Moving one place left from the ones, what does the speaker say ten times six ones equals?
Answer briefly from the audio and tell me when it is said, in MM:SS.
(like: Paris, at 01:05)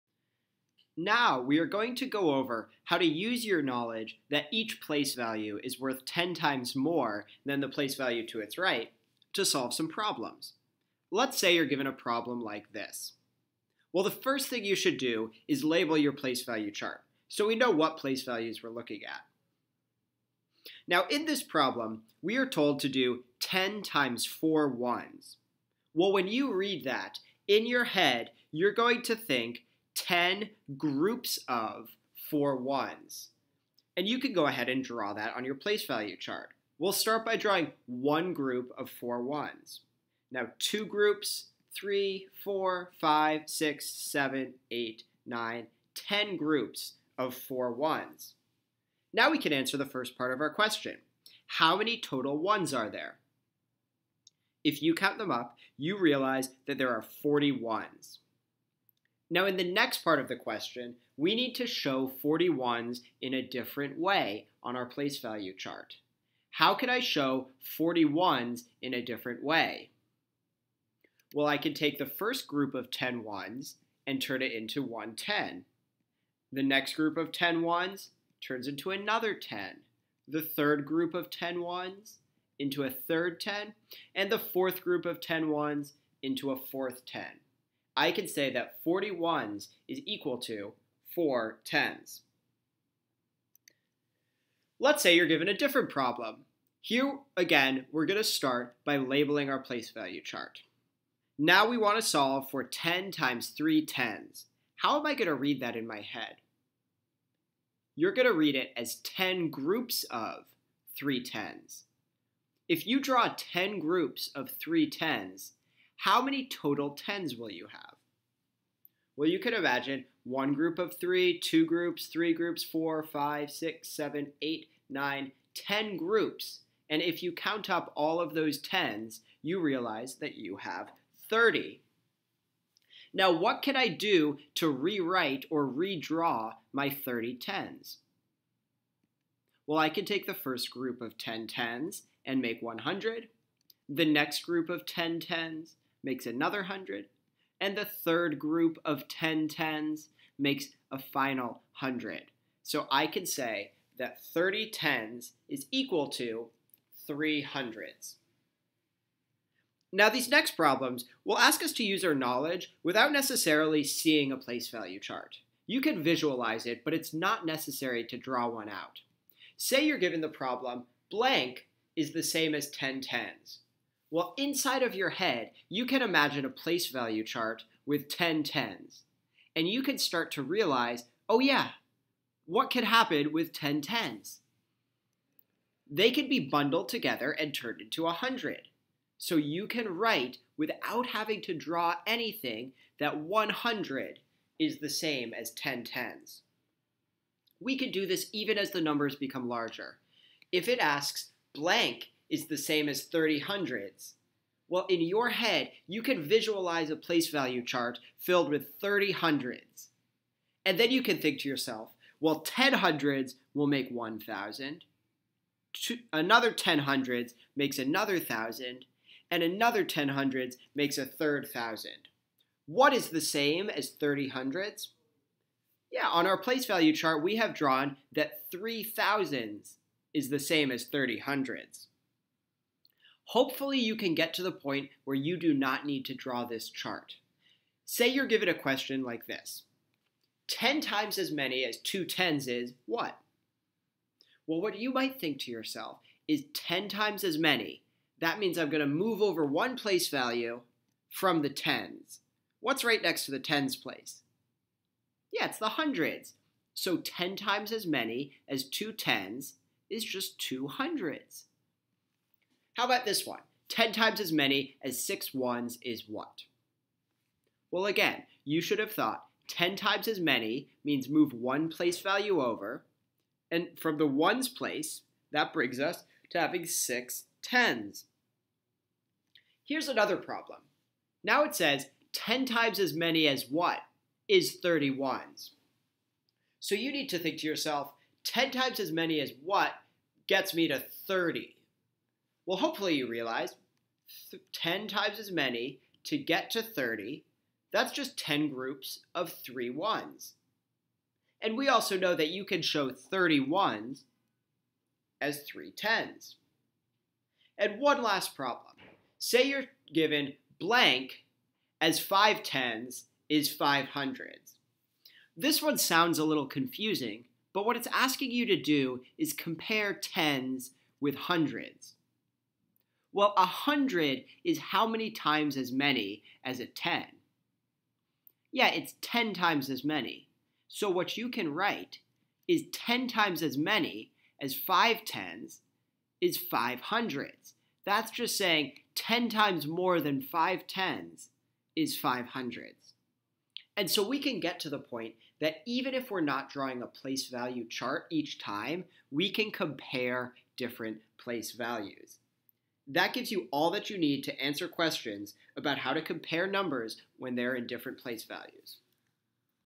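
6 tens, at 04:36.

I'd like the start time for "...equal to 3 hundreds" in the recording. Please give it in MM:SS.
02:35.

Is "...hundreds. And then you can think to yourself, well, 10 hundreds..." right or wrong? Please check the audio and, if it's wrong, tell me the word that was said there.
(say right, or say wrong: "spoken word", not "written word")
right.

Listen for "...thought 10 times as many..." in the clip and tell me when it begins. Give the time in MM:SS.
04:28.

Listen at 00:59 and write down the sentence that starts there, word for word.
Now, in the next part of the question, we need to show 41s in a different way on our place value chart.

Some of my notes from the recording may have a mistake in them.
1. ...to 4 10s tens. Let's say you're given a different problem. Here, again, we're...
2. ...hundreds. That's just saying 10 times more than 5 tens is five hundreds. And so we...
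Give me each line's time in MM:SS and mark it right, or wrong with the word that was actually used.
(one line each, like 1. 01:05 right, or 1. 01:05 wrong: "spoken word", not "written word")
1. 01:30 right
2. 05:36 right.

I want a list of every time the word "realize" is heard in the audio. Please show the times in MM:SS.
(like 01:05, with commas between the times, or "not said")
00:55, 02:09, 03:00, 04:53.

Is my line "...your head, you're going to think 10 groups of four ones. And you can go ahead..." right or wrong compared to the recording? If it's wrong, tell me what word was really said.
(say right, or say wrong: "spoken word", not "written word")
right.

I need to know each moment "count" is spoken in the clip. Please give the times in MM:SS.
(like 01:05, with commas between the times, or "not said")
00:54, 02:07.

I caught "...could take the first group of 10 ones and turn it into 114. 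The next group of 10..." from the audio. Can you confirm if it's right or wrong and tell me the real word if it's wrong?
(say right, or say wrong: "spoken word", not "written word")
wrong: "110", not "114".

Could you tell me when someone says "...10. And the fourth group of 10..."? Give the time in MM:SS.
01:23.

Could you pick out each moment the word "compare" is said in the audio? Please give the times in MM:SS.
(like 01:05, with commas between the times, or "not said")
05:19, 05:49, 05:56.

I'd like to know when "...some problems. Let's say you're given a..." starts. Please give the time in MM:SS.
00:09.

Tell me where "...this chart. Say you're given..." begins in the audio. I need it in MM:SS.
03:56.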